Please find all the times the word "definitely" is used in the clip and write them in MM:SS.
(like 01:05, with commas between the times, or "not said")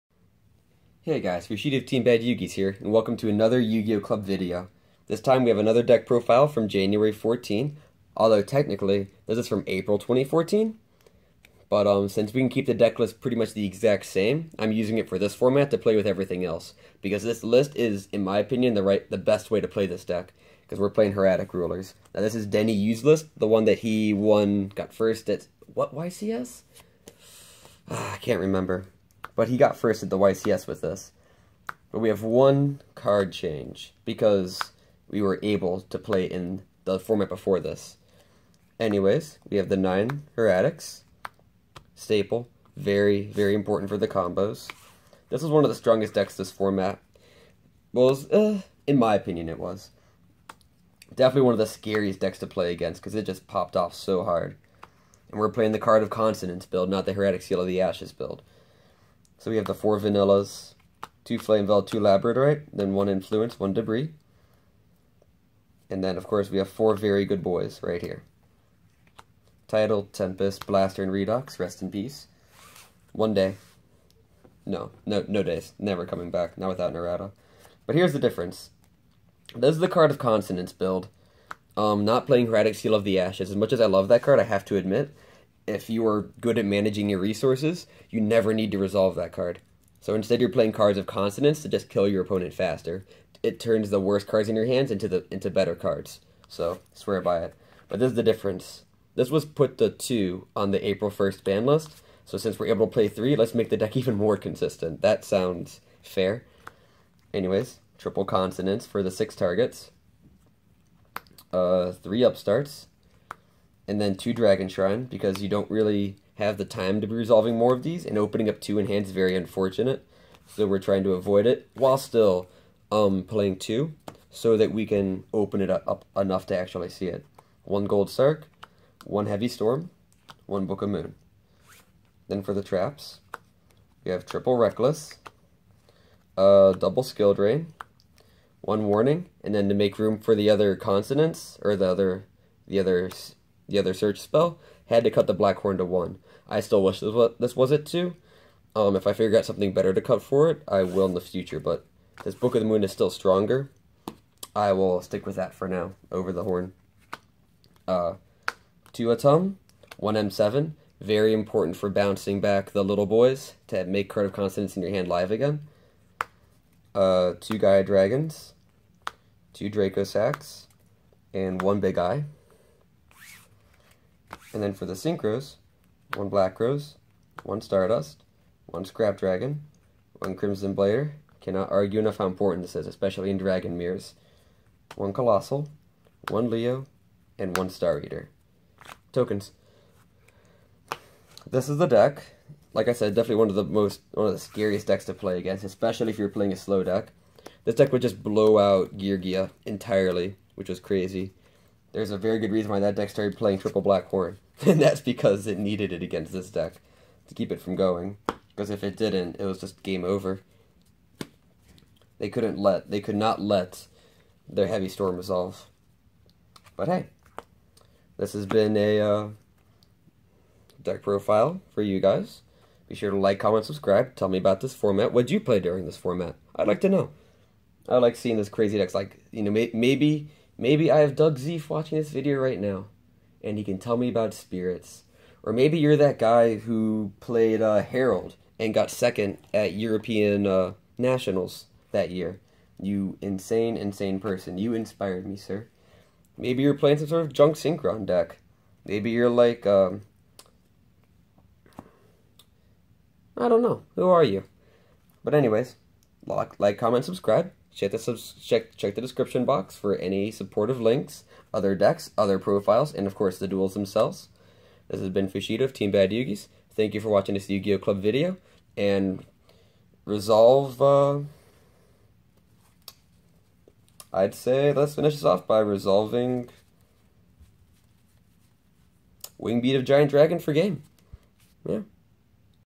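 00:51, 03:13.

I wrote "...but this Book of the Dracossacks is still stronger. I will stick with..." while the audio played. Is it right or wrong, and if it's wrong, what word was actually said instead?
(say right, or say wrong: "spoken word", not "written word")
wrong: "Moon", not "Dracossacks".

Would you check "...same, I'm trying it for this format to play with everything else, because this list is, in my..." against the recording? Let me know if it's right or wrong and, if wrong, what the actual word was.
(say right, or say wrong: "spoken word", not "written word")
wrong: "using", not "trying".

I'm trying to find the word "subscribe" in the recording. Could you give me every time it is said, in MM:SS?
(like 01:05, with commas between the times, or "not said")
03:43, 04:17.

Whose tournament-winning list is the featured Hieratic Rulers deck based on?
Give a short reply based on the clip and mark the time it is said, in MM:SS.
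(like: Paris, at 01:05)
Denny Yu, at 00:22.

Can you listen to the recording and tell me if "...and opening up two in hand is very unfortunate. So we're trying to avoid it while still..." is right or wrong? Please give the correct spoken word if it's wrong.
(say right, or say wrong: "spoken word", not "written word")
right.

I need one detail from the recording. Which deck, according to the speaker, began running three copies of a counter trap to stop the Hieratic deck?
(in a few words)
Geargia.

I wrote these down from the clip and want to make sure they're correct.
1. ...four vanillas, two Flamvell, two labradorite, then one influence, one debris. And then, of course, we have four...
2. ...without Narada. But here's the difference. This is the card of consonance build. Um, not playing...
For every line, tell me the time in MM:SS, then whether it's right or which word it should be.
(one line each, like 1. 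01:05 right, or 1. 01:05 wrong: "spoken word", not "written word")
1. 00:59 right
2. 01:16 right.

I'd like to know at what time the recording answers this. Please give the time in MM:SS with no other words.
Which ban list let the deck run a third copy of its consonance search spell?
01:40.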